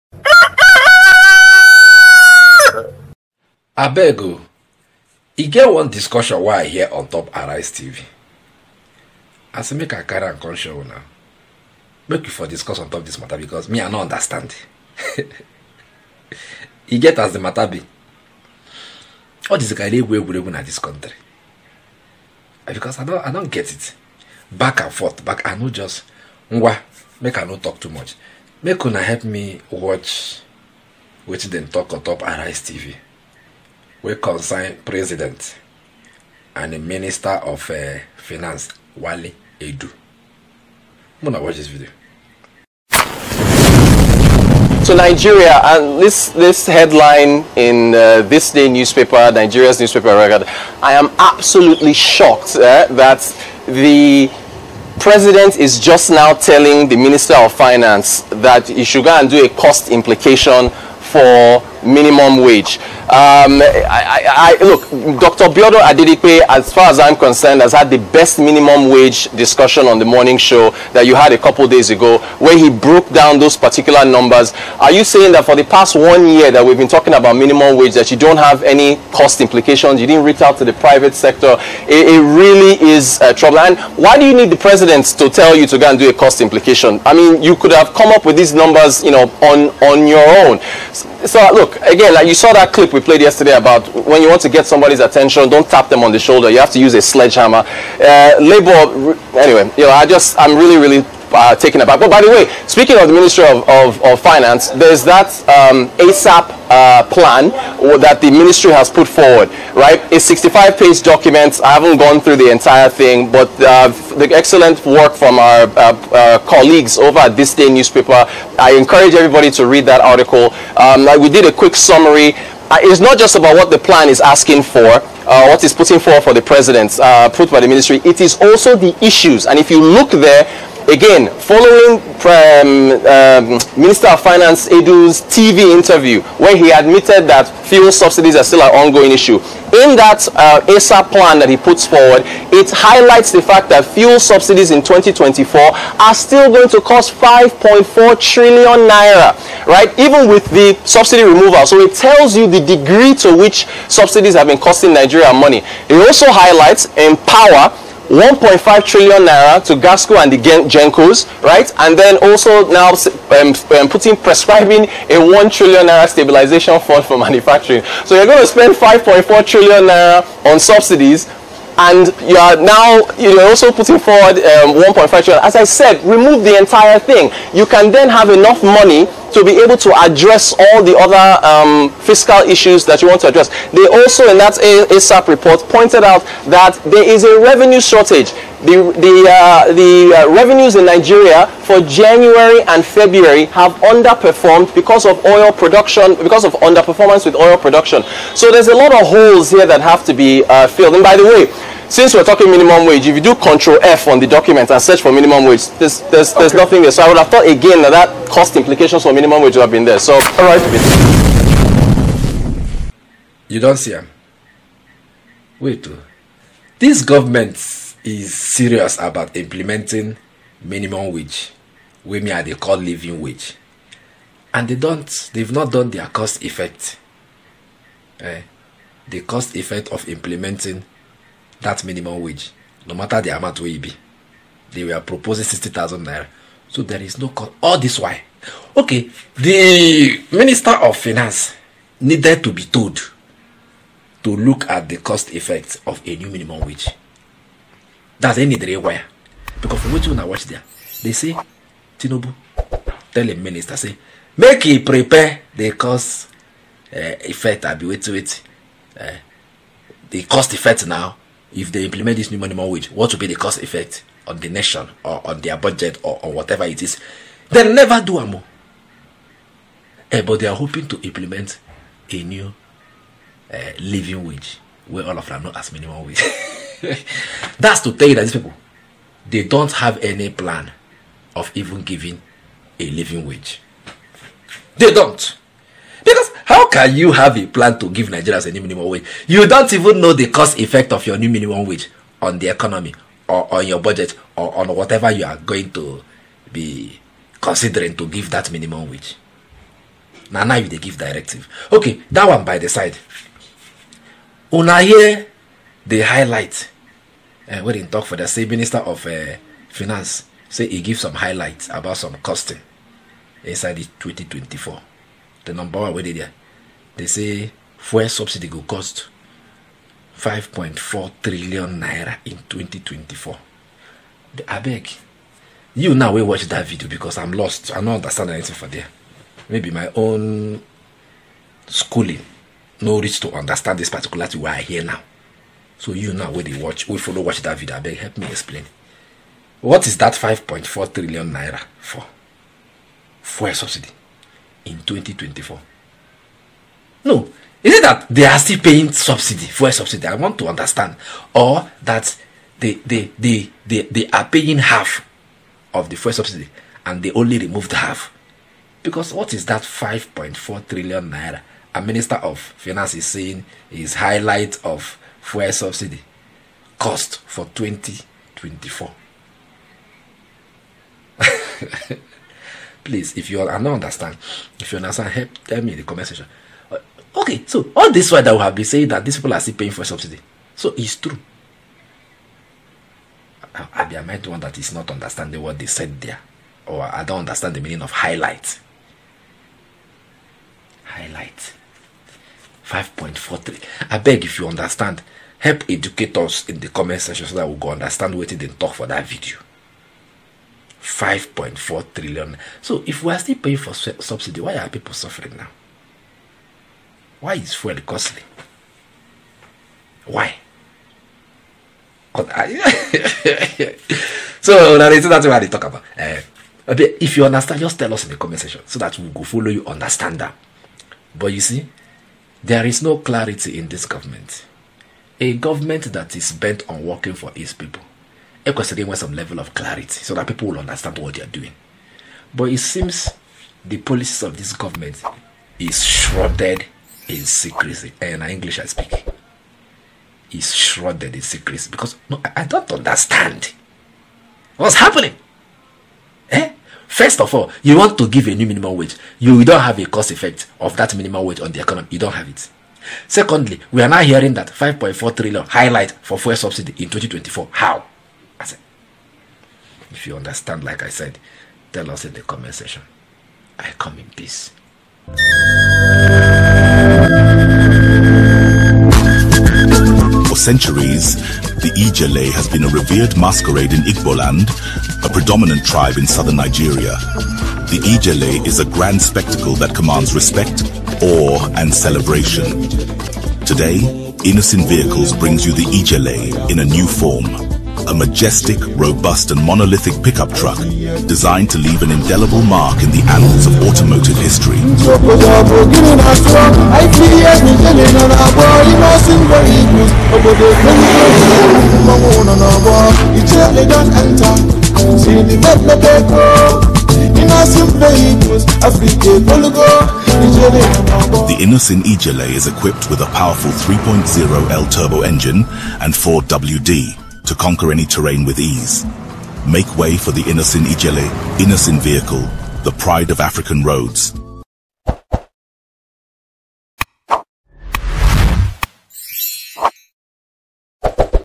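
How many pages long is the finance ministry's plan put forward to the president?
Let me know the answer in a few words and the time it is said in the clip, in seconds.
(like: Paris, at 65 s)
65, at 110 s.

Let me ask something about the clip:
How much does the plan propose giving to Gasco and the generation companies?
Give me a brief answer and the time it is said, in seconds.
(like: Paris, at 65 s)
1.5 trillion naira, at 158 s.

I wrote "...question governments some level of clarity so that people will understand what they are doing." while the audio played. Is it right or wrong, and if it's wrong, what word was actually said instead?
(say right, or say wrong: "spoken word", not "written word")
wrong: "wants", not "governments".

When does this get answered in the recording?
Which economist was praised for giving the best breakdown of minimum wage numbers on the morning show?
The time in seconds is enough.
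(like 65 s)
65 s.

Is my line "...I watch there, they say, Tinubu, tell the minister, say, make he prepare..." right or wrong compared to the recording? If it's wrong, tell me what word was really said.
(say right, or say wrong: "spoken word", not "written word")
right.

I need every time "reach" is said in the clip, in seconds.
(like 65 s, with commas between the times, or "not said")
80 s, 332 s.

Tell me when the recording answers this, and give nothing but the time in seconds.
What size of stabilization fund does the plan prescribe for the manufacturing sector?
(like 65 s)
165 s.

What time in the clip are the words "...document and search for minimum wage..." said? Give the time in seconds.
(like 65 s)
204 s.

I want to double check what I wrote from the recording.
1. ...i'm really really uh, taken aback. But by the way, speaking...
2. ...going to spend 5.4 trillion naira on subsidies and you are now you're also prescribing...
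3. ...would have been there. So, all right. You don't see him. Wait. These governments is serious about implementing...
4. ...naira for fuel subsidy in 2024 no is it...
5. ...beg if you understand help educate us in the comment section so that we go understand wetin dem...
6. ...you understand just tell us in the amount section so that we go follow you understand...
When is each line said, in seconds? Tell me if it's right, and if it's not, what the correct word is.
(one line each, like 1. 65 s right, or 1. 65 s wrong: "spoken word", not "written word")
1. 100 s right
2. 168 s wrong: "putting", not "prescribing"
3. 209 s right
4. 341 s right
5. 394 s right
6. 417 s wrong: "comment", not "amount".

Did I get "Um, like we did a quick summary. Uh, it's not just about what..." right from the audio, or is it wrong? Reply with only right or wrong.
right.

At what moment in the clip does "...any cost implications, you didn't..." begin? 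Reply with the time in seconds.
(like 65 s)
78 s.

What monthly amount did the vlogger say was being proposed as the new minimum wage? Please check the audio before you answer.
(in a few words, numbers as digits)
60,000 naira.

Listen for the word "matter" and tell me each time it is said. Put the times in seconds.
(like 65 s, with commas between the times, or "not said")
13 s, 17 s, 232 s.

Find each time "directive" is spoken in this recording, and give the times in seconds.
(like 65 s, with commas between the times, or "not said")
300 s.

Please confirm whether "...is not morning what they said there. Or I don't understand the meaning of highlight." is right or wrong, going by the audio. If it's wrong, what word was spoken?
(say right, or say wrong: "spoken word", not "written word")
wrong: "understanding", not "morning".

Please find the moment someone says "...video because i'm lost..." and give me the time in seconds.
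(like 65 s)
326 s.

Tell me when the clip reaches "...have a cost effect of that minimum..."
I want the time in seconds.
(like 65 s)
449 s.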